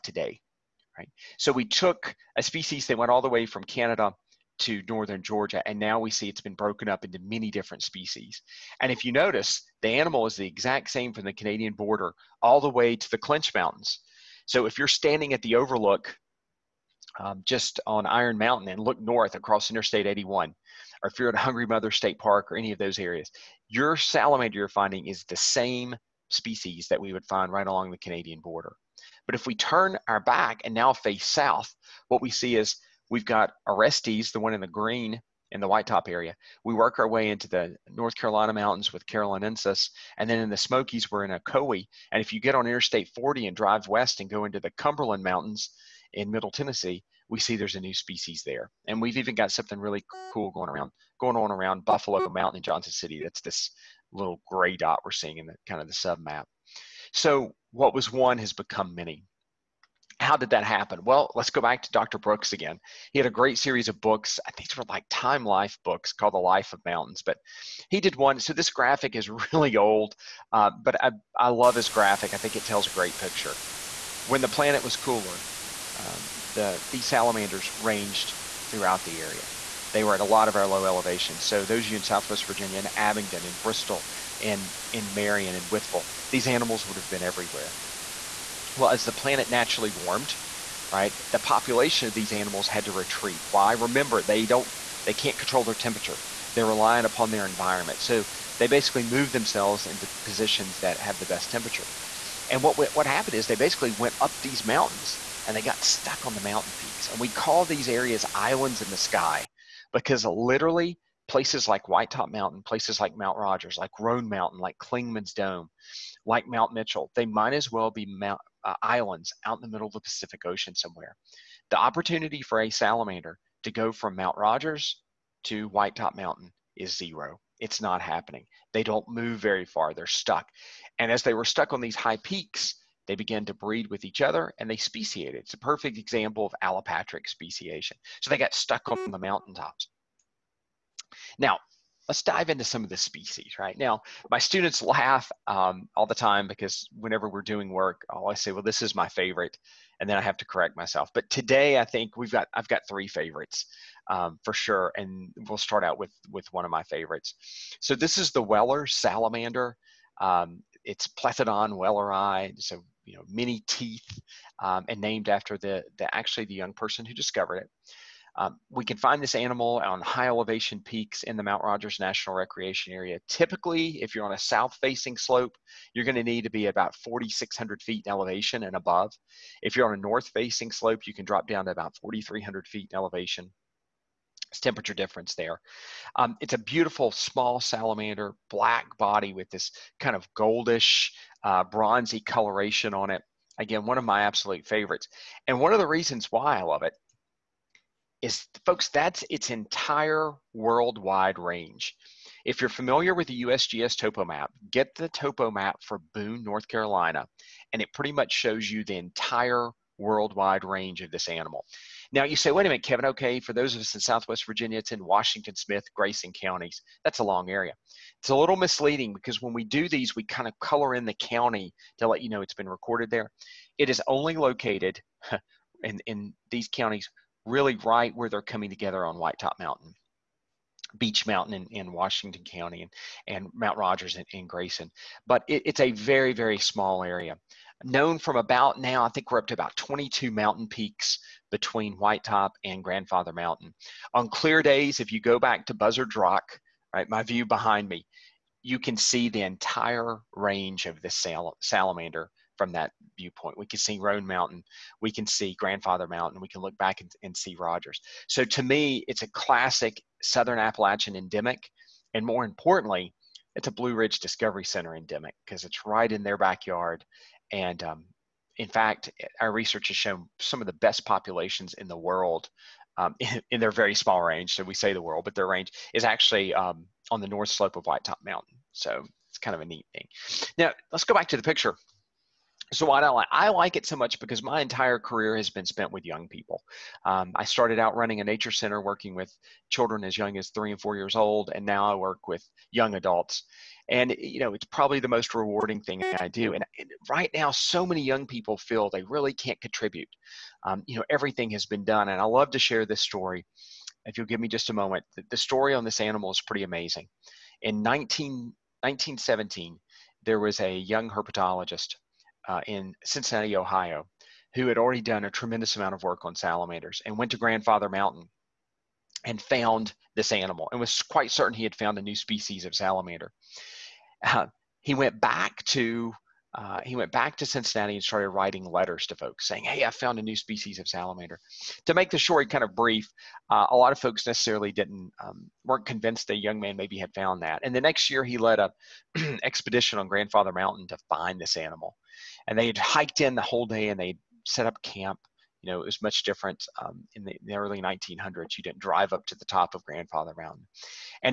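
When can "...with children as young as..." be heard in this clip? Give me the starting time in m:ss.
4:49.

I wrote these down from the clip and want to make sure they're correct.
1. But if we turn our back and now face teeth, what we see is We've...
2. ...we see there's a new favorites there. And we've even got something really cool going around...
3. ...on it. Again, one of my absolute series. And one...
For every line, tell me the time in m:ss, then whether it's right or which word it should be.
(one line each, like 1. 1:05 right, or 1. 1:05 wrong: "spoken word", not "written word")
1. 0:29 wrong: "south", not "teeth"
2. 0:47 wrong: "species", not "favorites"
3. 3:12 wrong: "favorites", not "series".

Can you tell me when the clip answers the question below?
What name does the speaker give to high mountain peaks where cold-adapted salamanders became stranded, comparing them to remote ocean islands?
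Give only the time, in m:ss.
1:48.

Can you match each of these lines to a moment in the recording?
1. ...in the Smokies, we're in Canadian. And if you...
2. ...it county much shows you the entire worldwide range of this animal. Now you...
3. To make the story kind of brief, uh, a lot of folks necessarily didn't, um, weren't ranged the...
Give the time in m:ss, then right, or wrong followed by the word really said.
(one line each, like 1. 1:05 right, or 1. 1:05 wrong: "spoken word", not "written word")
1. 0:40 wrong: "Ocoee", not "Canadian"
2. 3:27 wrong: "pretty", not "county"
3. 5:31 wrong: "convinced", not "ranged".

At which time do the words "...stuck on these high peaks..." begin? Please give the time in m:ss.
2:11.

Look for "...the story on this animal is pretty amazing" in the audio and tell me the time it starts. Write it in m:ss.
5:05.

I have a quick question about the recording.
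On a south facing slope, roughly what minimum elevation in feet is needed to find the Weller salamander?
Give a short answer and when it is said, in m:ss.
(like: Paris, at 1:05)
4,600 feet, at 2:56.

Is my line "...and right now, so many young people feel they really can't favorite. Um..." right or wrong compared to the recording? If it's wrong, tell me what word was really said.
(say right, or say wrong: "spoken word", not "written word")
wrong: "contribute", not "favorite".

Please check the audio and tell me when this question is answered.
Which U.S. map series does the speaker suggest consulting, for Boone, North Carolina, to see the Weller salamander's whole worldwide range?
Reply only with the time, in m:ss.
3:23.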